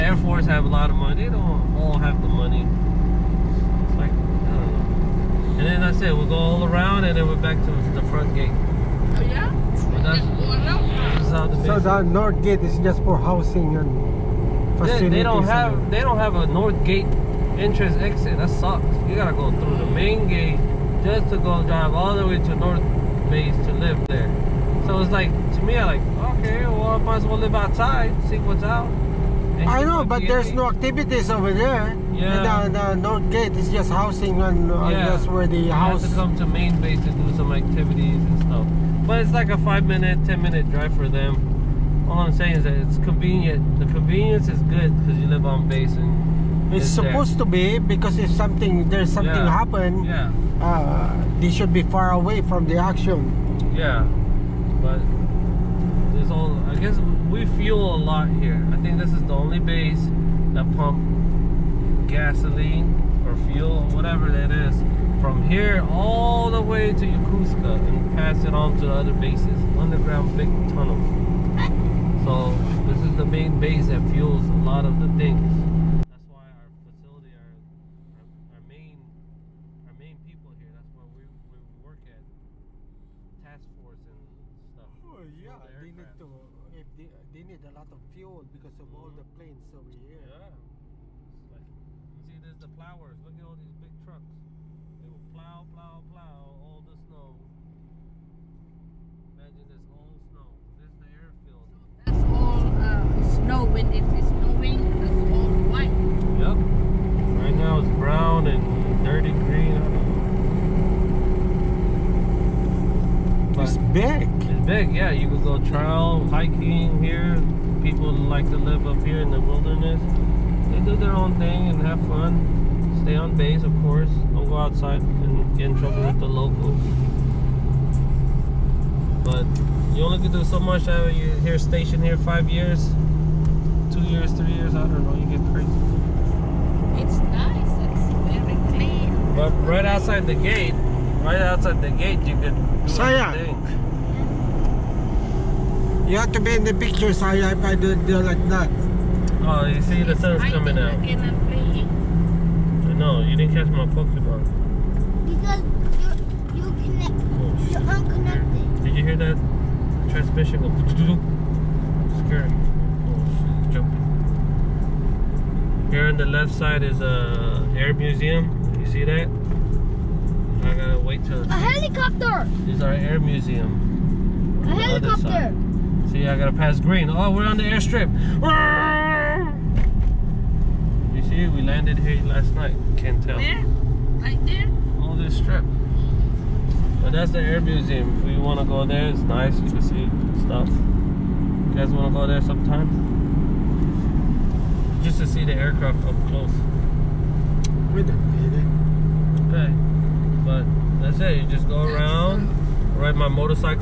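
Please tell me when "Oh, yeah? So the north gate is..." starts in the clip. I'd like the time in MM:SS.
00:08.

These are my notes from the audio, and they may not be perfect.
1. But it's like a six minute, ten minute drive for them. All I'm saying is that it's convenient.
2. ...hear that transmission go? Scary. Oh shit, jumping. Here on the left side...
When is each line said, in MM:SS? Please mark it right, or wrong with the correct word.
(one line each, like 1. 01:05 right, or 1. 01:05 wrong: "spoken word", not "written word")
1. 00:39 wrong: "five", not "six"
2. 02:39 right.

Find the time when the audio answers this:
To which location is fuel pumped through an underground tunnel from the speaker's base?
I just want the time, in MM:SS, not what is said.
01:07.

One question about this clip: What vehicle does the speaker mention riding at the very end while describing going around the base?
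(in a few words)
Motorcycle.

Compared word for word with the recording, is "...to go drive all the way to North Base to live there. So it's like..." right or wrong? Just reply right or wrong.
right.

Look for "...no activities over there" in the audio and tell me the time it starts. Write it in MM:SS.
00:30.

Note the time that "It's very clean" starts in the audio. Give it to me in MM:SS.
02:17.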